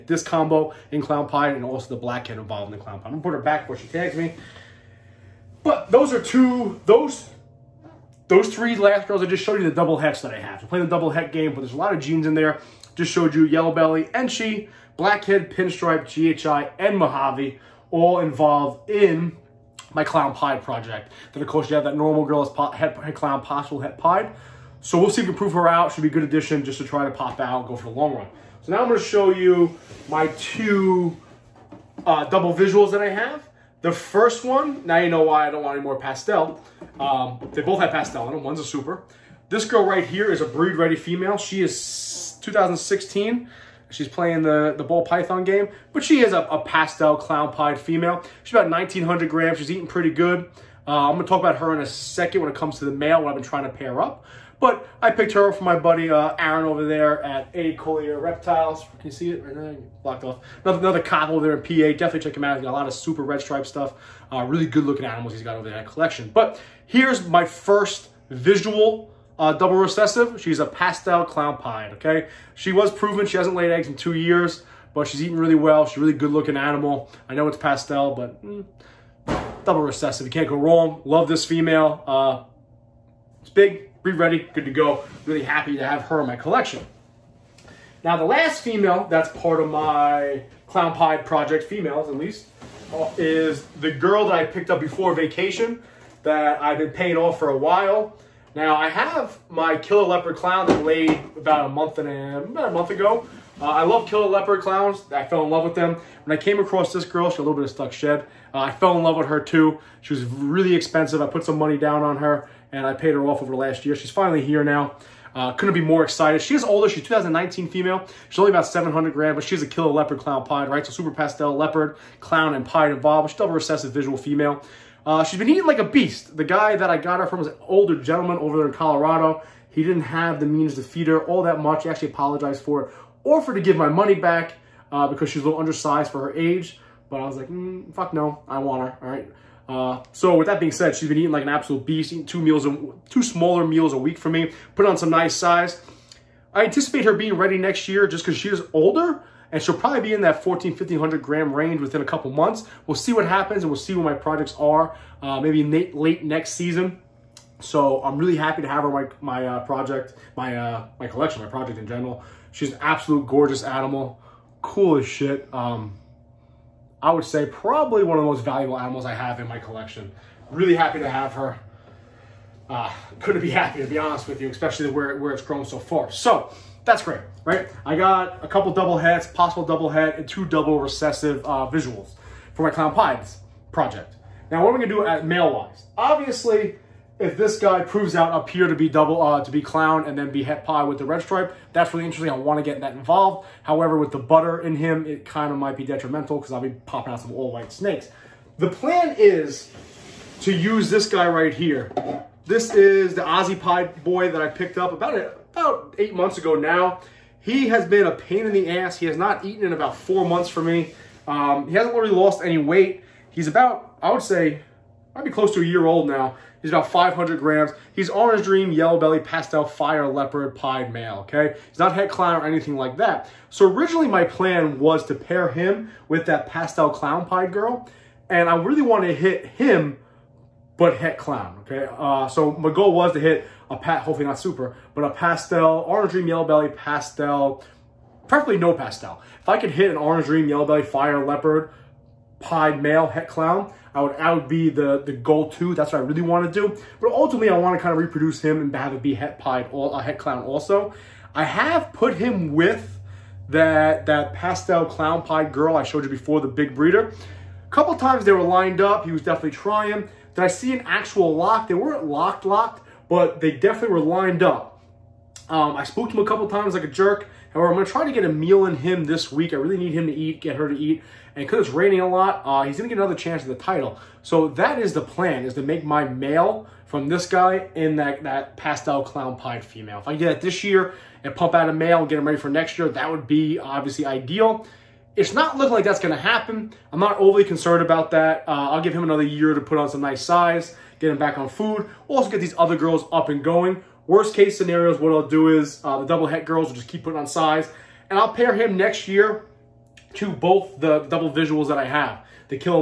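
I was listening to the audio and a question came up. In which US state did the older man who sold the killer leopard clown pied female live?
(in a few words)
Colorado.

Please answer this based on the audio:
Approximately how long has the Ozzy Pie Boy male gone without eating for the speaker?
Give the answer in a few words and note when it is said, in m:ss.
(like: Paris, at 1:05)
4 months, at 3:29.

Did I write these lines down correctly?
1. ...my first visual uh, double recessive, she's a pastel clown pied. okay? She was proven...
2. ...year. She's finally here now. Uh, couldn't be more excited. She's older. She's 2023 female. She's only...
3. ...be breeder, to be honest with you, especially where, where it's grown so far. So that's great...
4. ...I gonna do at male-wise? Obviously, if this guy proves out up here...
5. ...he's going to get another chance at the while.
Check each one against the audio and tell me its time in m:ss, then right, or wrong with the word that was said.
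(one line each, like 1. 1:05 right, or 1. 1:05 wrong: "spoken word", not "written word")
1. 1:07 right
2. 1:53 wrong: "2019", not "2023"
3. 2:53 wrong: "happier", not "breeder"
4. 3:04 right
5. 4:32 wrong: "title", not "while".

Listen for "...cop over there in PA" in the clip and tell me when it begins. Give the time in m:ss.
1:01.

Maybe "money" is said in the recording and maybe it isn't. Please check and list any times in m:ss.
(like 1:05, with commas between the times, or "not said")
1:51, 2:13.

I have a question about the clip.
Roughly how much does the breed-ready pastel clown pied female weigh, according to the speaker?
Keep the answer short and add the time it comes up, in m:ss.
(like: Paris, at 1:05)
1,900 grams, at 0:48.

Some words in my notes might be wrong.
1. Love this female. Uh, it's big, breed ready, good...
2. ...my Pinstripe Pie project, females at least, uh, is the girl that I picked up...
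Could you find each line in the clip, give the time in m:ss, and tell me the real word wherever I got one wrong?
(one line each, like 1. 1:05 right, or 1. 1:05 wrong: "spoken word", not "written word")
1. 1:21 right
2. 1:29 wrong: "Clown", not "Pinstripe".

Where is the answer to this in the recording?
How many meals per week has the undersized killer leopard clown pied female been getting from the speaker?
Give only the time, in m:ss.
2:23.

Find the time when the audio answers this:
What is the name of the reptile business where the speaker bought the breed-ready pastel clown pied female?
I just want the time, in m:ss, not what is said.
0:57.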